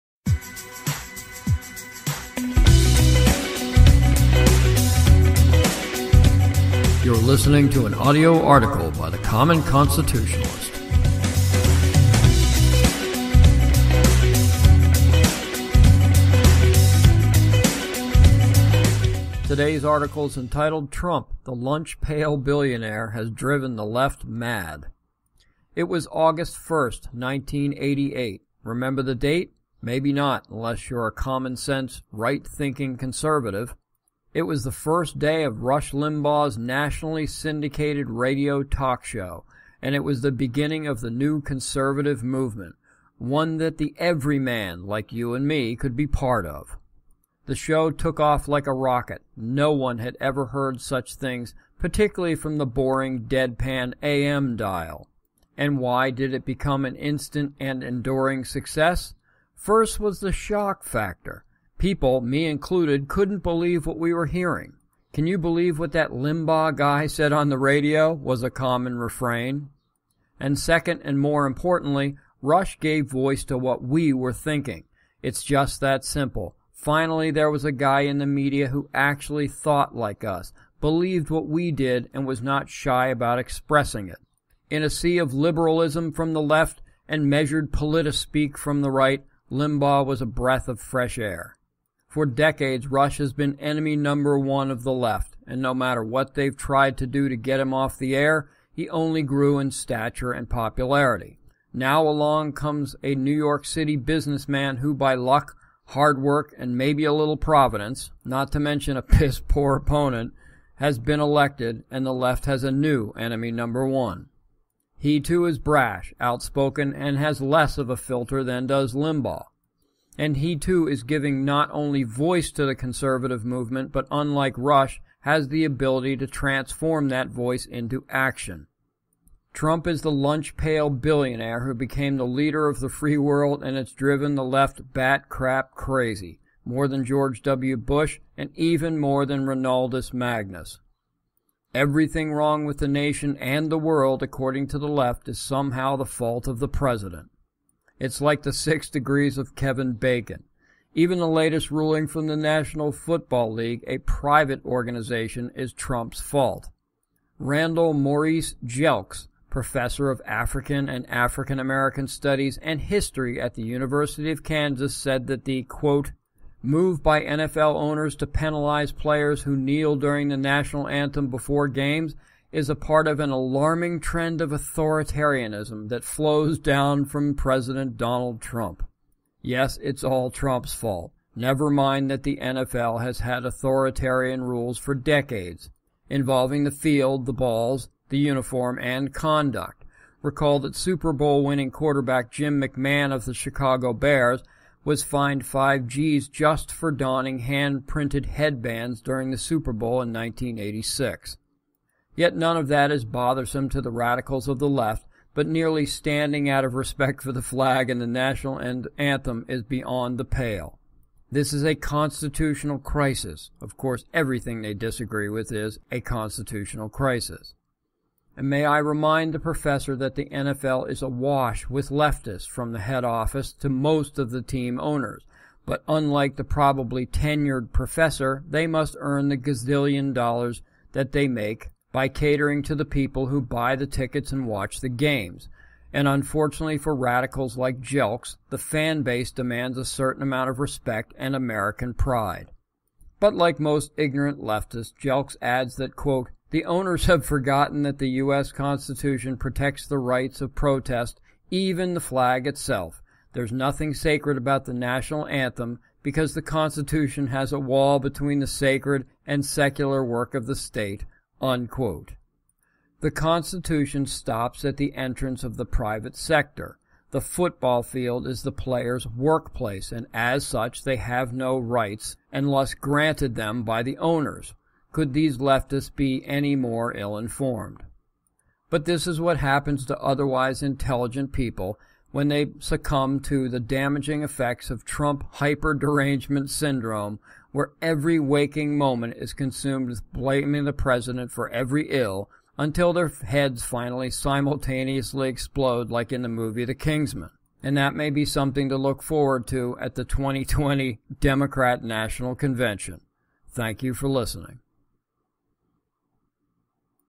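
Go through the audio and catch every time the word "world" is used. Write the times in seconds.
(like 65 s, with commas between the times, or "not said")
133 s, 143 s.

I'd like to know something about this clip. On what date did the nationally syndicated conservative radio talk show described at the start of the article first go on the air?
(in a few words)
August 1st, 1988.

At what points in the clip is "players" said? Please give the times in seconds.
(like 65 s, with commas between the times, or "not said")
168 s, 268 s.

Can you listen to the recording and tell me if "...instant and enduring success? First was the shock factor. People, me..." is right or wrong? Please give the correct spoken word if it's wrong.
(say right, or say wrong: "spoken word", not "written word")
right.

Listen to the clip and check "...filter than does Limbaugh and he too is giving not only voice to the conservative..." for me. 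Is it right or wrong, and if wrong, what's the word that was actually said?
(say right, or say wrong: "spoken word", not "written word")
right.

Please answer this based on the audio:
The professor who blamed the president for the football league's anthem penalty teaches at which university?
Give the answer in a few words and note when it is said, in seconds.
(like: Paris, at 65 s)
University of Kansas, at 163 s.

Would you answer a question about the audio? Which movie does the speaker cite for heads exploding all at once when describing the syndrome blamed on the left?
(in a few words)
The Kingsman.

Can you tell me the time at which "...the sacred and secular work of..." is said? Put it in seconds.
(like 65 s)
258 s.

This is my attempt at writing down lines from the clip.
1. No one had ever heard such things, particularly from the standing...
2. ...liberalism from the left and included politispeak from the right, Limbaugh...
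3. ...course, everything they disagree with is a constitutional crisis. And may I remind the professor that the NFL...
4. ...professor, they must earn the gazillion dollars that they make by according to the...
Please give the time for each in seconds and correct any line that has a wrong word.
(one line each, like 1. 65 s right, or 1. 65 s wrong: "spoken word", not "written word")
1. 49 s wrong: "boring", not "standing"
2. 85 s wrong: "measured", not "included"
3. 213 s right
4. 227 s wrong: "catering", not "according".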